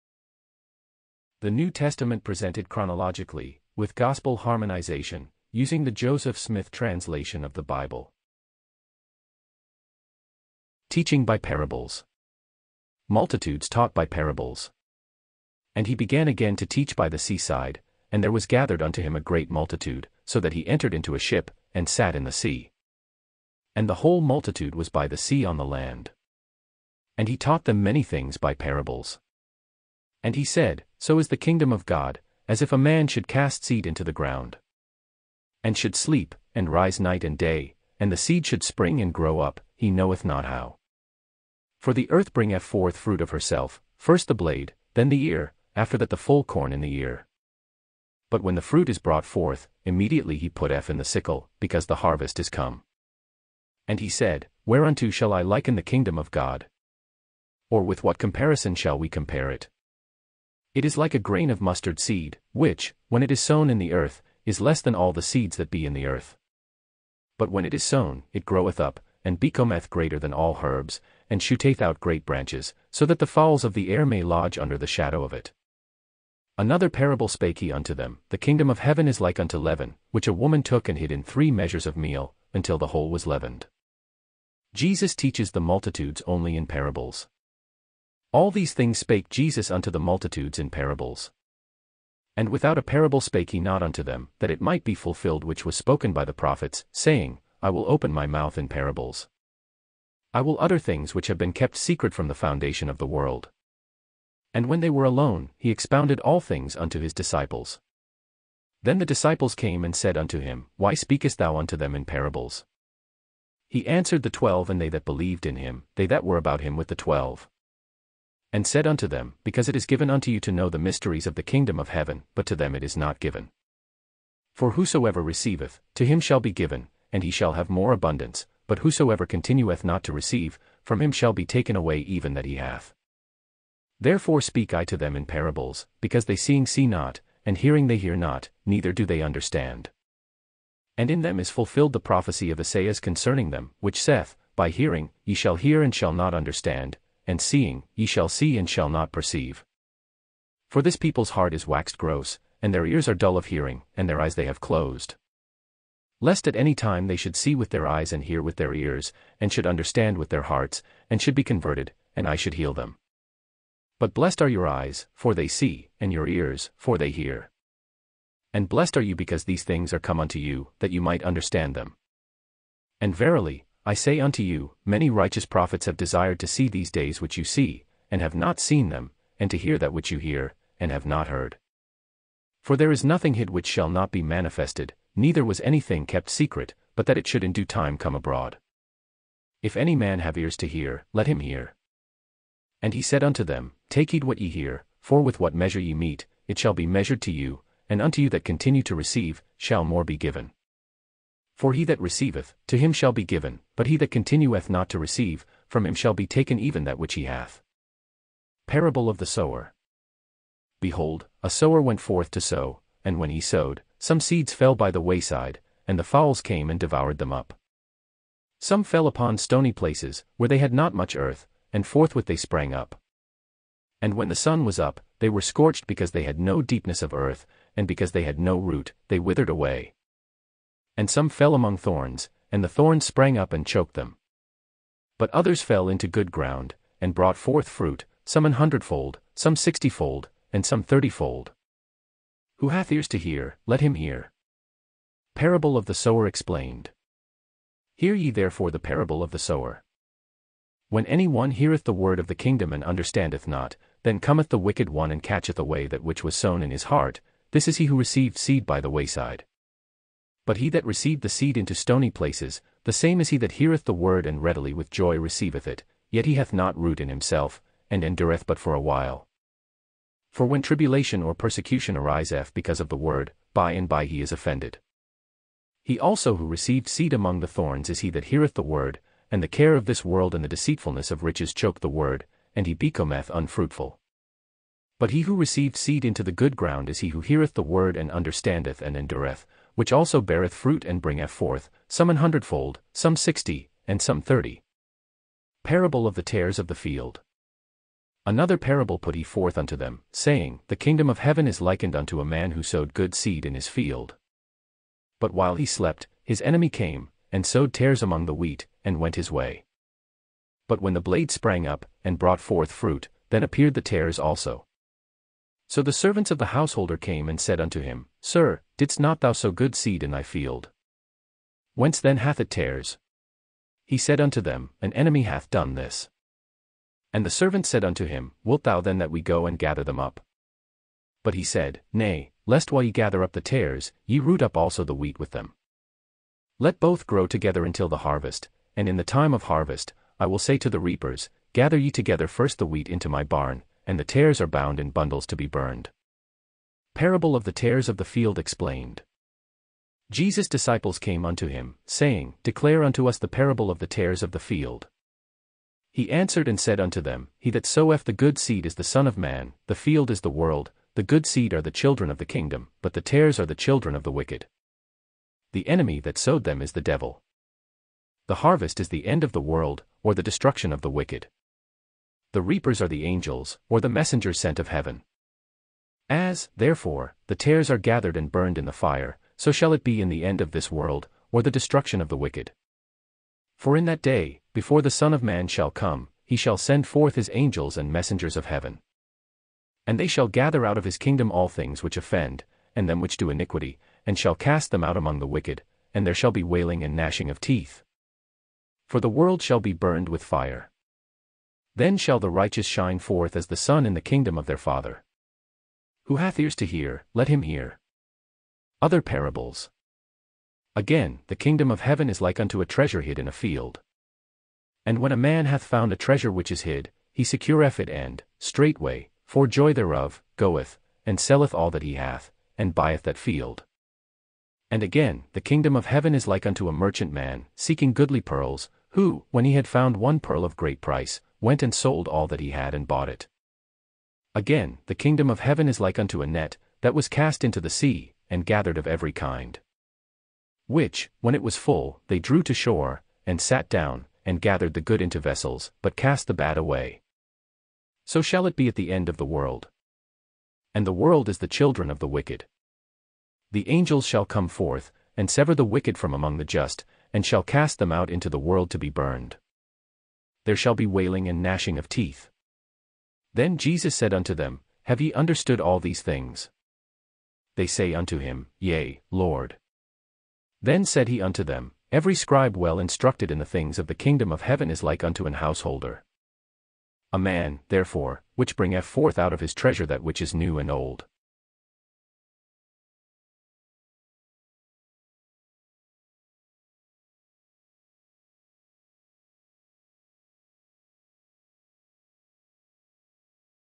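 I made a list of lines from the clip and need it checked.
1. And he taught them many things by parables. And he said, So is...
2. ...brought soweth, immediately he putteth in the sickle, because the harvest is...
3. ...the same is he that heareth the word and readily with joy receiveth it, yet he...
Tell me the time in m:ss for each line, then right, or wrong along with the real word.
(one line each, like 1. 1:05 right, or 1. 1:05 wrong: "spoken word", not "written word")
1. 0:27 right
2. 0:48 wrong: "forth", not "soweth"
3. 4:22 right.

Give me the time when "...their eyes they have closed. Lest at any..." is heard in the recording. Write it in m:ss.
2:34.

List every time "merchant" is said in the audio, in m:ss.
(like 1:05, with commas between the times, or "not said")
7:06.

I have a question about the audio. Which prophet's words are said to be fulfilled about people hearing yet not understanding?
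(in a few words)
Esaias.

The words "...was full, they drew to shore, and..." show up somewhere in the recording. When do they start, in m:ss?
7:21.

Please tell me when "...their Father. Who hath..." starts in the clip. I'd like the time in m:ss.
6:44.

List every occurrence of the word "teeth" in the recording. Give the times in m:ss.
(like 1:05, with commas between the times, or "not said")
6:37, 7:41.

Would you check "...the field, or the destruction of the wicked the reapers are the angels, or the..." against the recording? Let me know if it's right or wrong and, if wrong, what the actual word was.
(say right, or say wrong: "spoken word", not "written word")
wrong: "world", not "field".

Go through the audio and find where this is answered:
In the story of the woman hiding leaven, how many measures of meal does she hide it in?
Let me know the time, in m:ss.
1:21.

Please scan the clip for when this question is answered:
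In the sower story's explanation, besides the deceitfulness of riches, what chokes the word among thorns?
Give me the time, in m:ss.
4:39.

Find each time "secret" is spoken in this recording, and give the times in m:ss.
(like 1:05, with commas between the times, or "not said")
1:41, 3:06.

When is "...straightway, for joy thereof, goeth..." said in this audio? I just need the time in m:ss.
6:58.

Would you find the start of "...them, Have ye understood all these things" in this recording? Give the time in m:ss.
7:44.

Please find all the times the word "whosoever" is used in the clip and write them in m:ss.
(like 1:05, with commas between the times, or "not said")
2:04, 2:08.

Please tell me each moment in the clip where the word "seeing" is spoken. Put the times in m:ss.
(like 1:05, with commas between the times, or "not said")
2:16, 2:27.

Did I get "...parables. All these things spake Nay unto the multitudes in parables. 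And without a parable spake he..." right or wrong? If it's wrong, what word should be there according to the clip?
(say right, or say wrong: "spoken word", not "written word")
wrong: "Jesus", not "Nay".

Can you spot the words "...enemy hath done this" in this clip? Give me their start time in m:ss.
5:24.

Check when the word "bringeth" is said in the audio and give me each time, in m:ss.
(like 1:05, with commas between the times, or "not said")
0:42, 4:51, 7:58.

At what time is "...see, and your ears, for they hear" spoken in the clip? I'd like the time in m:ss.
2:45.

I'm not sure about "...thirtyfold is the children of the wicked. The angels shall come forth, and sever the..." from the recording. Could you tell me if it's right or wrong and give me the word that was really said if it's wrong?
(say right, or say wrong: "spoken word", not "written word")
wrong: "world", not "thirtyfold".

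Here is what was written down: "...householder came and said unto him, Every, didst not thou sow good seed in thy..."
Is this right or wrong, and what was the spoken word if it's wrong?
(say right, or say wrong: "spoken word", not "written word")
wrong: "Sir", not "Every".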